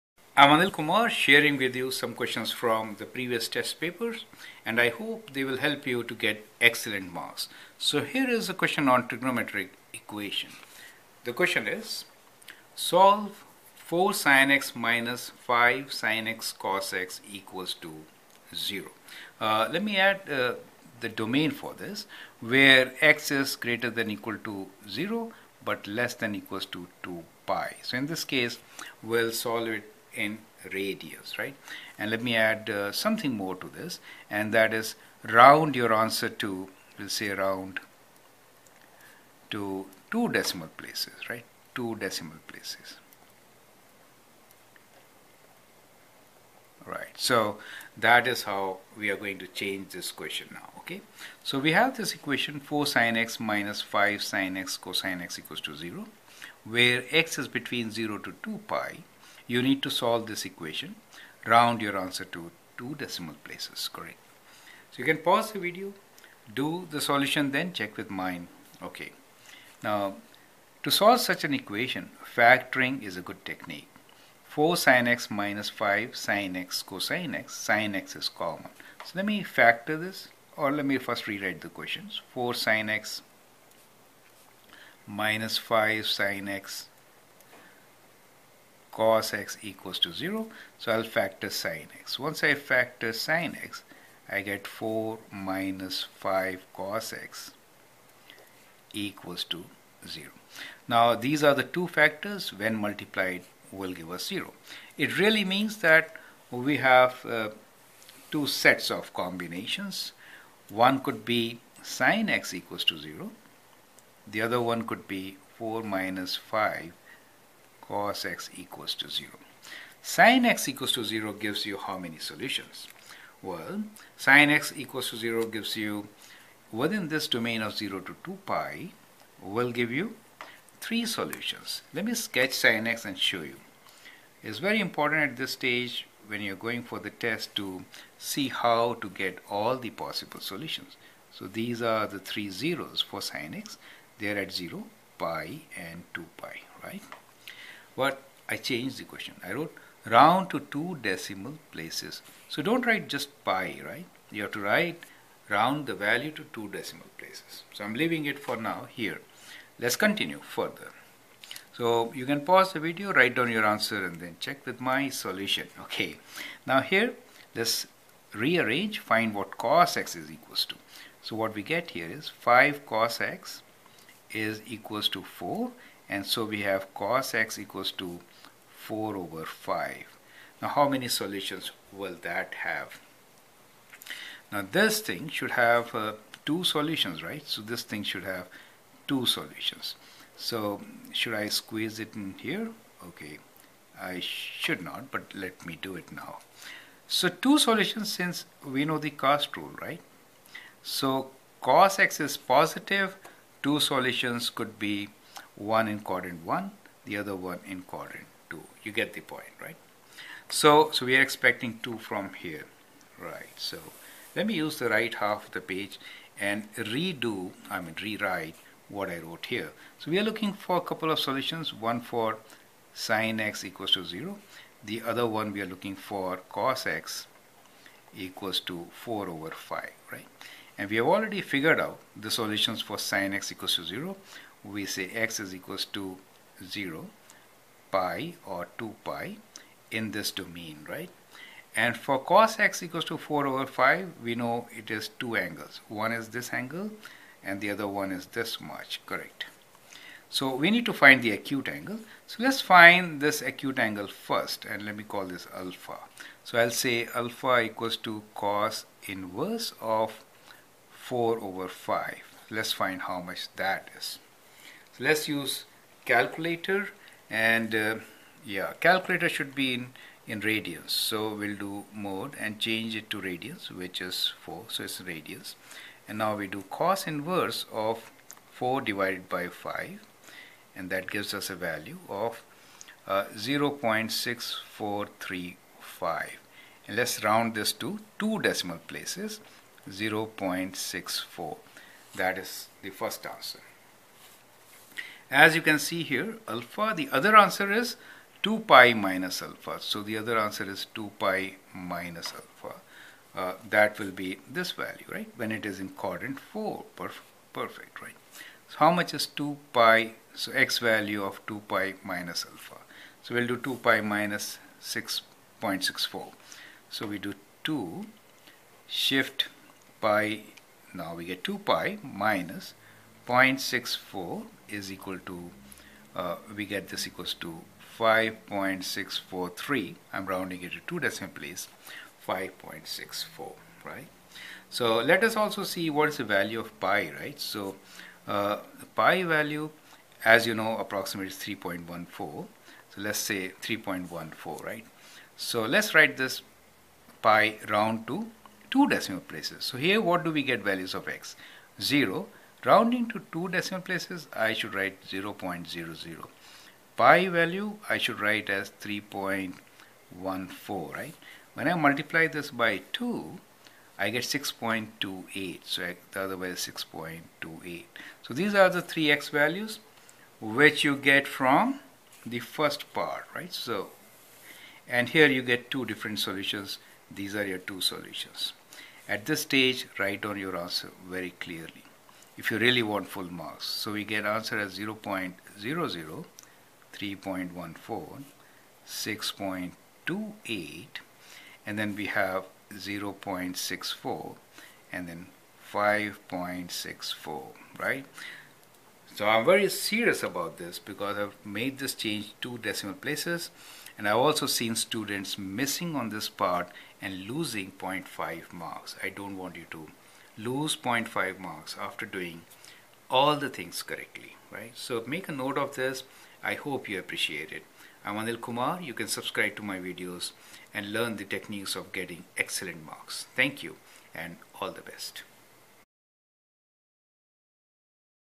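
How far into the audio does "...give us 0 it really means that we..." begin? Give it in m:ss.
1:44.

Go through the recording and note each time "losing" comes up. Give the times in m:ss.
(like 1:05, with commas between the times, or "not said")
6:47.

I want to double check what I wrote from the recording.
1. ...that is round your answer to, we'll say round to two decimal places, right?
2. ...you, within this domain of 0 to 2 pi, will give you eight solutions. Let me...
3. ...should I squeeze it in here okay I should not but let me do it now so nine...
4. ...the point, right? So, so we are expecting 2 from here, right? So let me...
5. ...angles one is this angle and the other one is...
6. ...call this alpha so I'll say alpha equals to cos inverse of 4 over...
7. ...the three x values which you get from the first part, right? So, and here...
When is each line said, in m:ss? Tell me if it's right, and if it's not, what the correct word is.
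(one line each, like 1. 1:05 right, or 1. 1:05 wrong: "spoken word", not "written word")
1. 0:34 right
2. 2:05 wrong: "three", not "eight"
3. 3:11 wrong: "two", not "nine"
4. 3:29 right
5. 4:05 right
6. 4:15 right
7. 6:08 right.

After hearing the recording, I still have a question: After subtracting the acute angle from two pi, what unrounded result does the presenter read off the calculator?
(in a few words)
5.643.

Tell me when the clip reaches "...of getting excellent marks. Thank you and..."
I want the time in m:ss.
7:01.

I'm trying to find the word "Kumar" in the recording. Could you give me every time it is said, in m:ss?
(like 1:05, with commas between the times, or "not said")
0:00, 6:58.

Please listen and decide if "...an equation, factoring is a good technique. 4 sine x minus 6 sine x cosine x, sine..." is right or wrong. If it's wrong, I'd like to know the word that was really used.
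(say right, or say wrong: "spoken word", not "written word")
wrong: "5", not "6".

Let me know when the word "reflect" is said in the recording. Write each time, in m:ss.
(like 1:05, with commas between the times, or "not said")
not said.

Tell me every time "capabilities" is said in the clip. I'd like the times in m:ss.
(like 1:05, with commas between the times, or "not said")
not said.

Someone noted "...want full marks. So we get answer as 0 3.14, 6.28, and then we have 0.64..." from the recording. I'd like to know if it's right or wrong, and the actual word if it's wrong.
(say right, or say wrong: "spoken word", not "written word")
right.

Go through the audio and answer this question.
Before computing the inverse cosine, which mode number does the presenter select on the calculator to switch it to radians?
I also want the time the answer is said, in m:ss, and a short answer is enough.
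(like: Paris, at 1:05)
4, at 4:33.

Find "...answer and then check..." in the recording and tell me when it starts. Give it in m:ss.
2:43.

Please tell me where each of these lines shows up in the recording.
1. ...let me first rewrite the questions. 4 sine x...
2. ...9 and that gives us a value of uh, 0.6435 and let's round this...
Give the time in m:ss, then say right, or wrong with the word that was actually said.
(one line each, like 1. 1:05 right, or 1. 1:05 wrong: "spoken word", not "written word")
1. 1:20 right
2. 4:39 wrong: "5", not "9".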